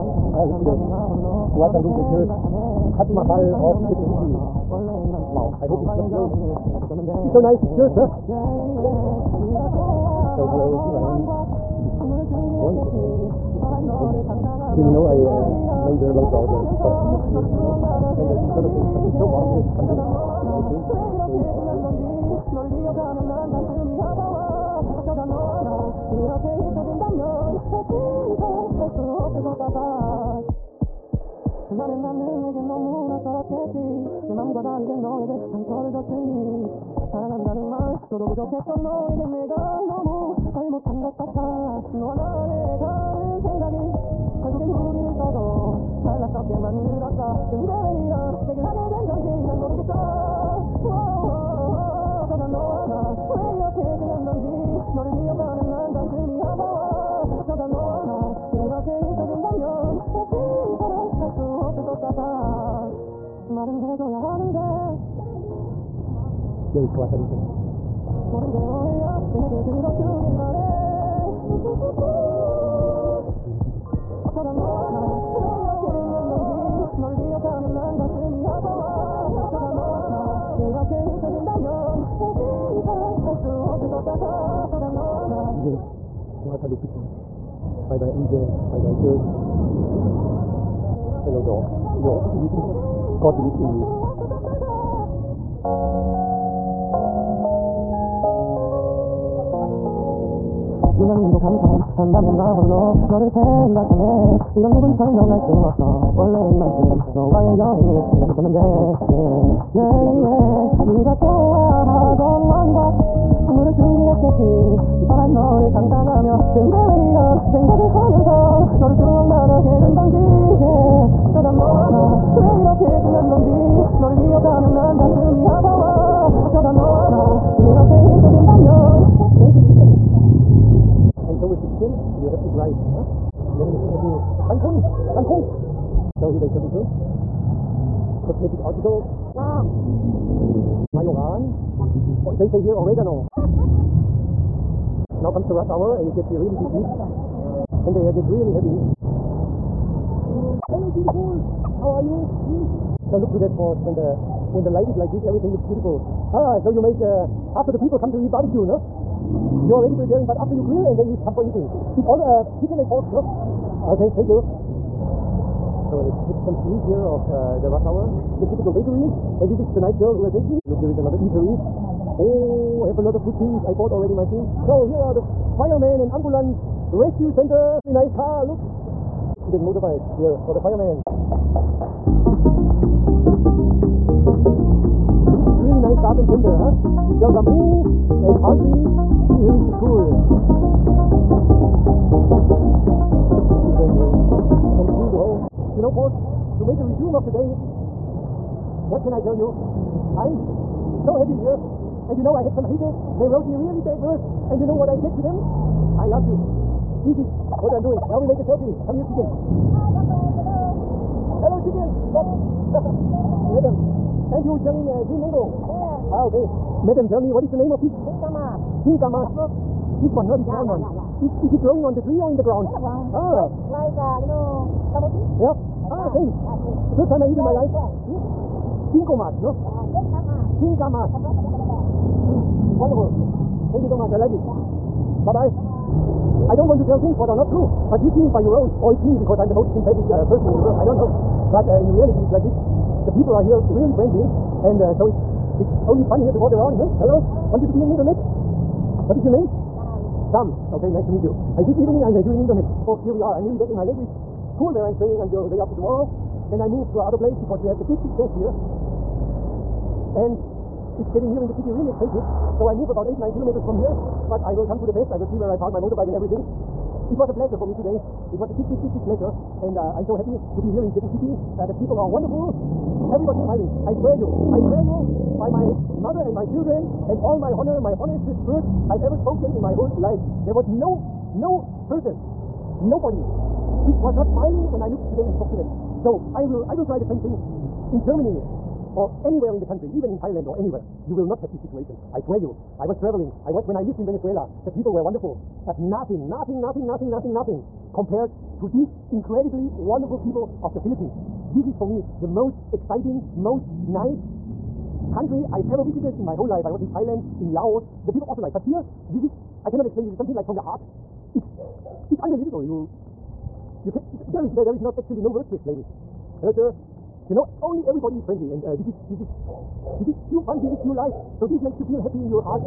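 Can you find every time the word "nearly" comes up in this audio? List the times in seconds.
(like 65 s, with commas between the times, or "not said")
253 s.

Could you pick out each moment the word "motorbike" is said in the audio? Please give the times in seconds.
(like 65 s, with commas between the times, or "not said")
179 s, 265 s.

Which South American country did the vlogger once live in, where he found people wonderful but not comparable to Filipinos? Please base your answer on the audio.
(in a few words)
Venezuela.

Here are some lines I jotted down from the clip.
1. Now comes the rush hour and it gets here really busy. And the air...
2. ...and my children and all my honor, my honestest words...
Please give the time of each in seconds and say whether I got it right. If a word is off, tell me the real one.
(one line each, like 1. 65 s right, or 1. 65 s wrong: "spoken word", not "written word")
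1. 145 s right
2. 276 s right.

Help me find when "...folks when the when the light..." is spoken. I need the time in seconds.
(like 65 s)
153 s.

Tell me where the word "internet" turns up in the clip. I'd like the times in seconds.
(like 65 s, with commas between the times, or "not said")
247 s, 252 s.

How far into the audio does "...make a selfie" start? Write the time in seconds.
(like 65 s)
208 s.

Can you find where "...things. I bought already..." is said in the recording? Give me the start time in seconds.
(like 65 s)
173 s.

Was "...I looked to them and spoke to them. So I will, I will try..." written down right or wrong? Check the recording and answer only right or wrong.
right.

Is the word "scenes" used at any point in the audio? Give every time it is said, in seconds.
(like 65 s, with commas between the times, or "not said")
166 s.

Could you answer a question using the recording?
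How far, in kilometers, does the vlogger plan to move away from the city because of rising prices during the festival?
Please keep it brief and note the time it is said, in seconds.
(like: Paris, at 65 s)
8 to 9 kilometers, at 263 s.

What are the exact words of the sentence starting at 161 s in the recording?
It's all uh, chicken and pork, no?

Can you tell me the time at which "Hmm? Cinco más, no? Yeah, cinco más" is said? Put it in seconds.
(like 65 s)
227 s.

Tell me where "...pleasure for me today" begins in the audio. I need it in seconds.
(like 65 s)
267 s.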